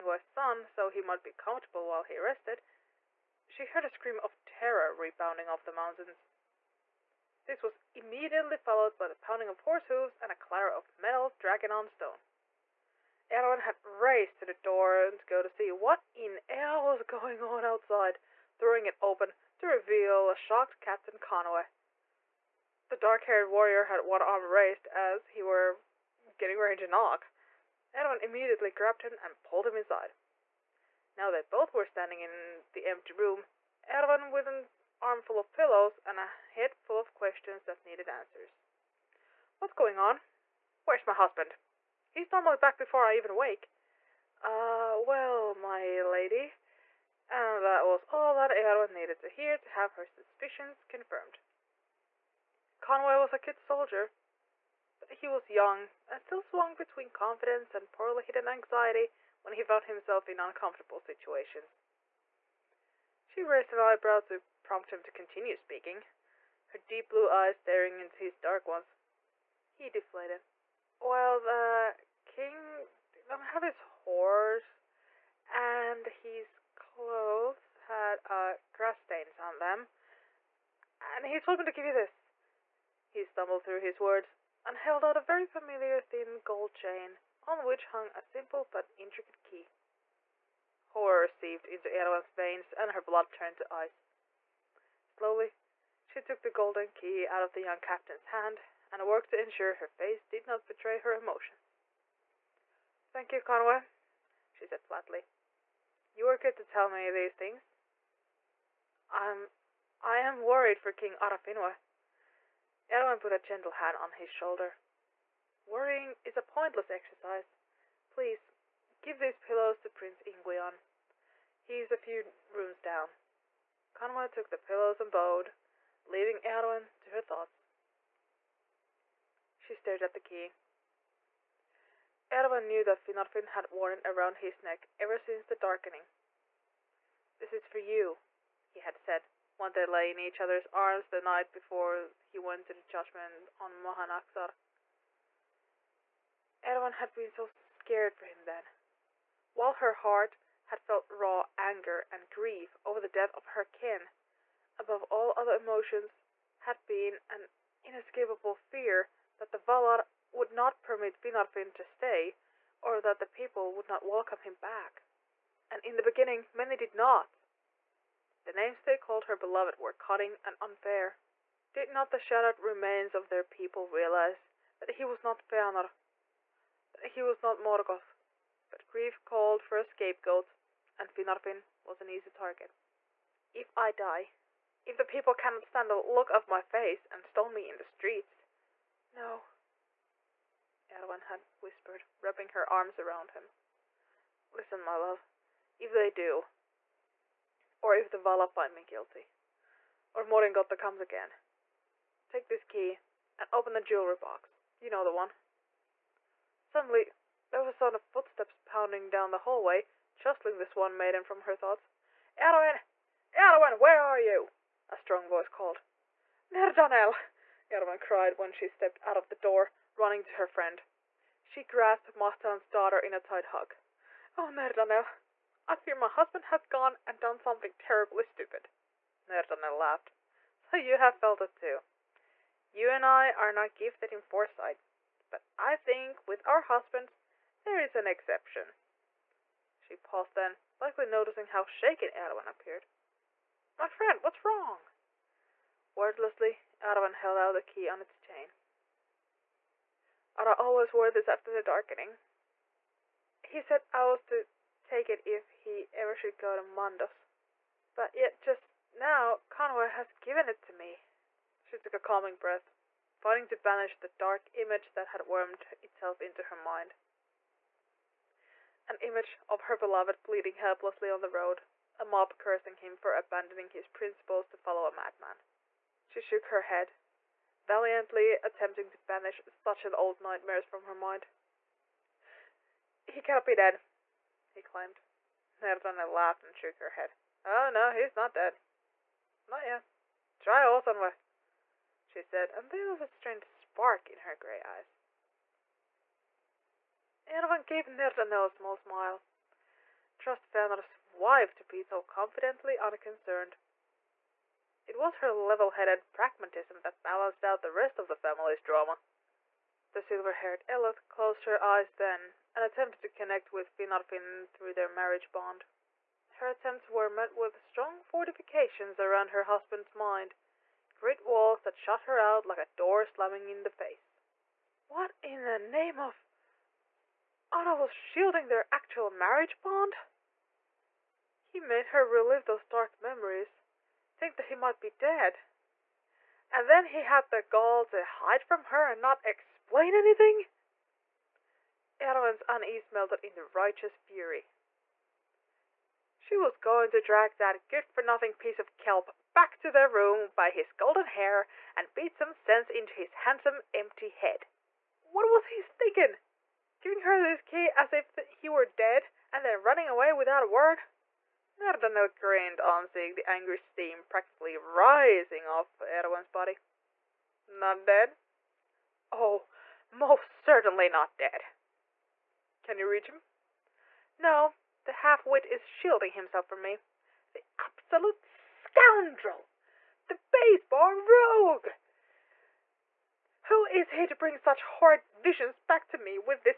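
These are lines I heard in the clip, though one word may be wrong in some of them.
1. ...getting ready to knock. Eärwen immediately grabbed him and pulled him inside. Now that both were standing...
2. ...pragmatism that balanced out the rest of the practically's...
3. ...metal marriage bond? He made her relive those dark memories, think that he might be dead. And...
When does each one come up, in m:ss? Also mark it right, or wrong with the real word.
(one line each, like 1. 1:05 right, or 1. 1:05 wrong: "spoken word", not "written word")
1. 0:26 right
2. 5:06 wrong: "family", not "practically"
3. 5:28 wrong: "actual", not "metal".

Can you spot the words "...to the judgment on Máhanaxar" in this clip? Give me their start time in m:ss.
2:22.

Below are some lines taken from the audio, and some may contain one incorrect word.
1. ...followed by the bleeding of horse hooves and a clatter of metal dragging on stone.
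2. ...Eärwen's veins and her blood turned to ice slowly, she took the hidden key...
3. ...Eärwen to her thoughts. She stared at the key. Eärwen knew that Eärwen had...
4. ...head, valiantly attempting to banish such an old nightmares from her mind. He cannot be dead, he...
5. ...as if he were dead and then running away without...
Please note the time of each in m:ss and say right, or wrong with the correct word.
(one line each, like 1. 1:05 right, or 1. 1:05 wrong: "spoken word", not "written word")
1. 0:08 wrong: "pounding", not "bleeding"
2. 1:31 wrong: "golden", not "hidden"
3. 2:06 wrong: "Finarfin", not "Eärwen"
4. 4:36 right
5. 5:57 right.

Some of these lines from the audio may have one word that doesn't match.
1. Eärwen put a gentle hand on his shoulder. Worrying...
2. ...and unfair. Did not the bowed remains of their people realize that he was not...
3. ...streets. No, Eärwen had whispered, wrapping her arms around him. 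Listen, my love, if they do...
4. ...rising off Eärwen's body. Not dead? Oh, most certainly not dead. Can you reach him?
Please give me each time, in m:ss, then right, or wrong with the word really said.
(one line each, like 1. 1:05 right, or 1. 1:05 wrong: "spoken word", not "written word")
1. 1:52 right
2. 2:50 wrong: "shattered", not "bowed"
3. 3:07 right
4. 6:04 right.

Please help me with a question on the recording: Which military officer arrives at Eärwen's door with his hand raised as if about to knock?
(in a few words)
Captain Conway.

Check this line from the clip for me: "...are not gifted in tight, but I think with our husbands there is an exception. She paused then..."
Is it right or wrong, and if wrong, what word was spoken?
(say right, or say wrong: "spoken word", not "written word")
wrong: "foresight", not "tight".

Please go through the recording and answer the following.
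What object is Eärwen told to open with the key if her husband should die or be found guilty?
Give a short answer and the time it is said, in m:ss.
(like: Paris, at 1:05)
the jewelry box, at 3:23.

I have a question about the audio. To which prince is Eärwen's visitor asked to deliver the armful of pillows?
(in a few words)
Prince Ingwion.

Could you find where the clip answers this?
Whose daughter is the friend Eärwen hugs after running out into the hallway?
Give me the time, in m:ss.
3:42.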